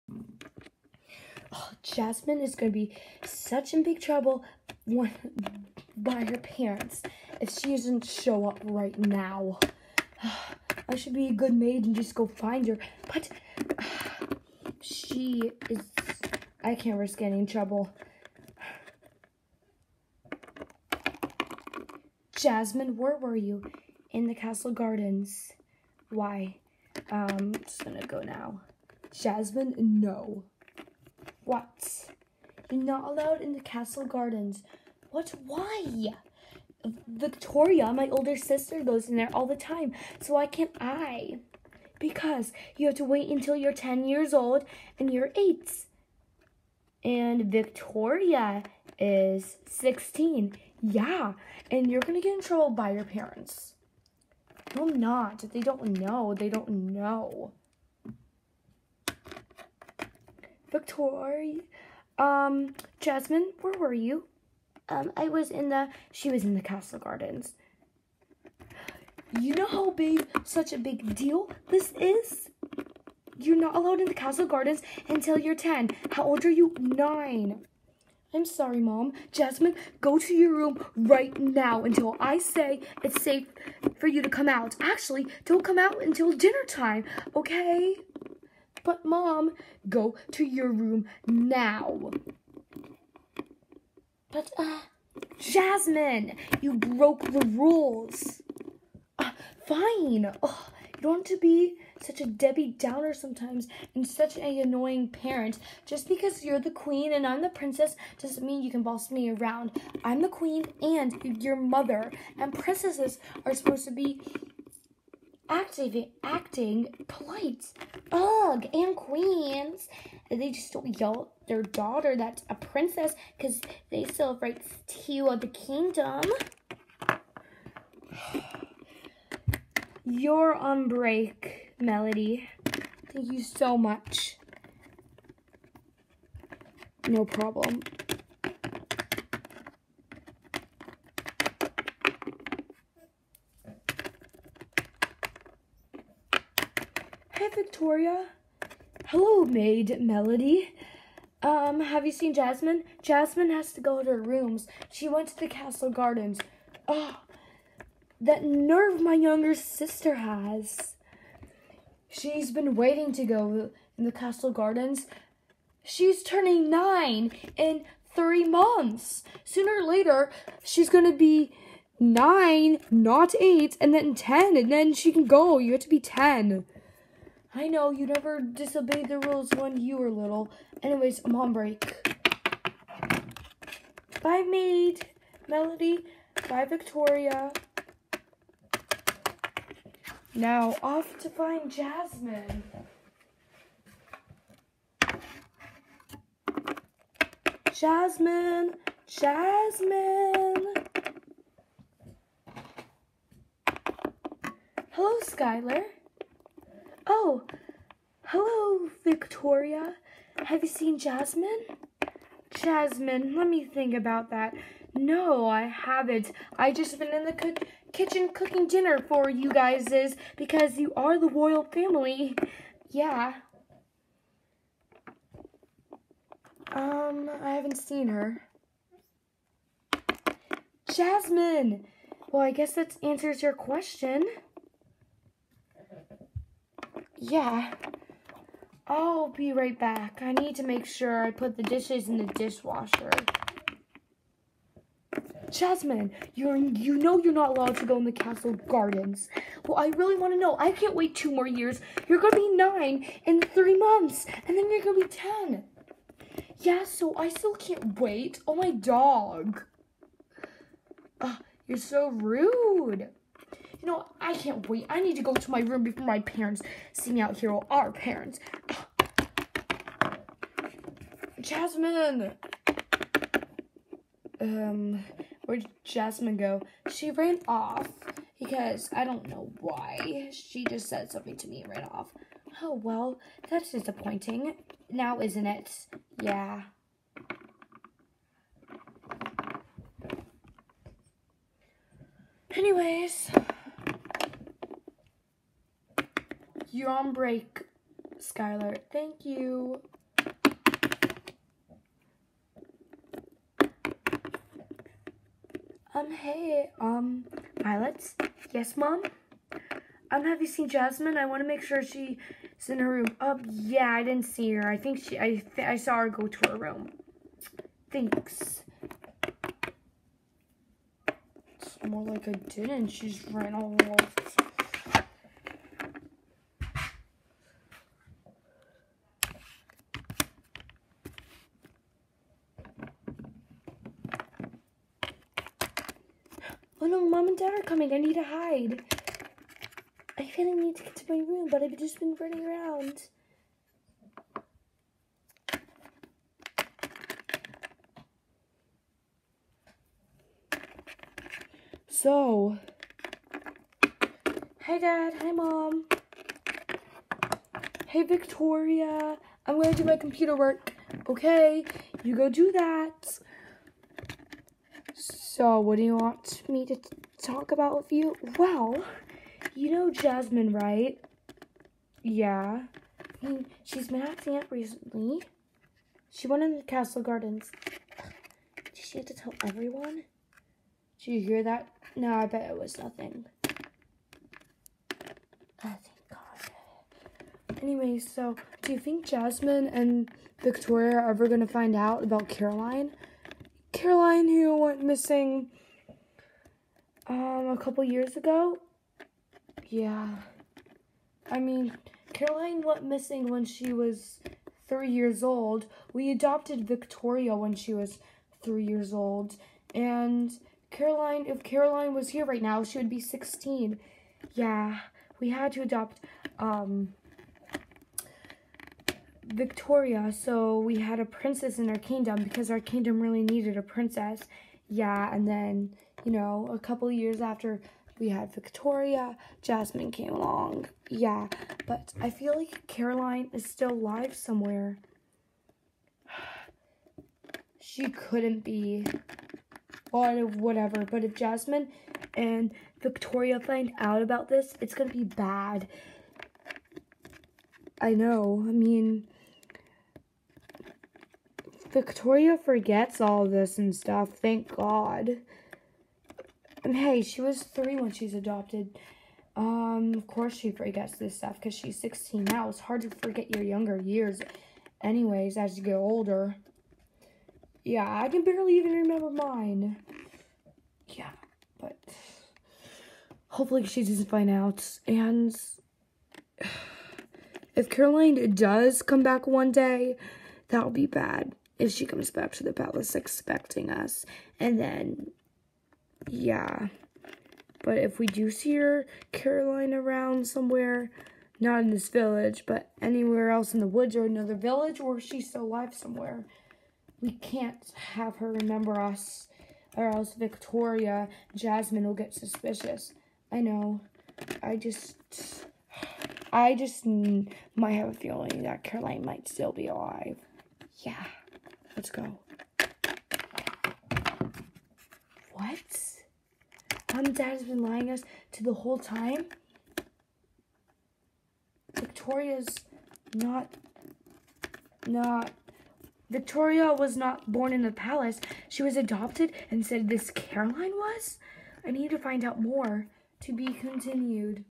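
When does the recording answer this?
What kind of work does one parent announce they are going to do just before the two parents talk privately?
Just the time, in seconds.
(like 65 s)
359 s.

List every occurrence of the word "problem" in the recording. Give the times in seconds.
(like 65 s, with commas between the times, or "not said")
137 s.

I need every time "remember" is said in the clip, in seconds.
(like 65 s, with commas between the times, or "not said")
468 s, 498 s.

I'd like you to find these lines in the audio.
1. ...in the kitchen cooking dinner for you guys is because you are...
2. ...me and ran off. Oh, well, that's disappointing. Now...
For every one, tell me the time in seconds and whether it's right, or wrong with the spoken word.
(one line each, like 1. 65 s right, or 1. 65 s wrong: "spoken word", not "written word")
1. 217 s right
2. 281 s right.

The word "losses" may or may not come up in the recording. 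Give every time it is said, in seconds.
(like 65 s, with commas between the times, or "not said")
not said.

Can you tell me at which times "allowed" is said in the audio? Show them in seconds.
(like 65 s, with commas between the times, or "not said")
33 s, 73 s, 247 s.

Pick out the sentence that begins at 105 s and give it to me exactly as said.
Just because you're the queen and I'm the princess doesn't mean you can boss me around.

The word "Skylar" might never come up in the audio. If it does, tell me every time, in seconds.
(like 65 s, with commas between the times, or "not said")
205 s, 298 s.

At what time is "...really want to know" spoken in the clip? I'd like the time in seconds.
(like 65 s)
249 s.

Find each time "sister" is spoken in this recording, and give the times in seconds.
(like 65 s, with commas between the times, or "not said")
38 s, 159 s.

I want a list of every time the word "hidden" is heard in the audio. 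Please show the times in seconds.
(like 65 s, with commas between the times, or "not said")
not said.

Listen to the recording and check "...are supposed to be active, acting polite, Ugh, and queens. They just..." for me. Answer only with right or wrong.
right.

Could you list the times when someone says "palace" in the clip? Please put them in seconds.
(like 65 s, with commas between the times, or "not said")
482 s, 527 s.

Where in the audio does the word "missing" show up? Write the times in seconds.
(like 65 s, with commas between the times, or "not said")
394 s, 402 s.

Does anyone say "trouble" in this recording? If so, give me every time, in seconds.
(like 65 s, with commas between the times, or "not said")
4 s, 17 s, 52 s.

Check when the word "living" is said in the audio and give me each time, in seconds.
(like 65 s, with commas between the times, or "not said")
not said.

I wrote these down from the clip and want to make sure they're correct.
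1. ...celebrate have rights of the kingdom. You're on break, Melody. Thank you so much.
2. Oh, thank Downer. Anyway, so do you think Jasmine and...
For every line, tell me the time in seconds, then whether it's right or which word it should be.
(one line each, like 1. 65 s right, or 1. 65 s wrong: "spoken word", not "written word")
1. 124 s right
2. 384 s wrong: "God", not "Downer".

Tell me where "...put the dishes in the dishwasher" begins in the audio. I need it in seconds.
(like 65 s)
241 s.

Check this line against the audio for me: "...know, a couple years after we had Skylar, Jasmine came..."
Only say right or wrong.
wrong.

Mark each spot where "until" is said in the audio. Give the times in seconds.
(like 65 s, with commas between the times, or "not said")
43 s, 75 s, 81 s, 86 s.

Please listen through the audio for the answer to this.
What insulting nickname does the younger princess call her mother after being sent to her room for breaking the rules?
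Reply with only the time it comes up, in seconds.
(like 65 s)
102 s.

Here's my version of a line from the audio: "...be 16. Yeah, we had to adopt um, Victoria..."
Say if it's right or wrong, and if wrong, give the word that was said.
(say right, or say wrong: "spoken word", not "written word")
right.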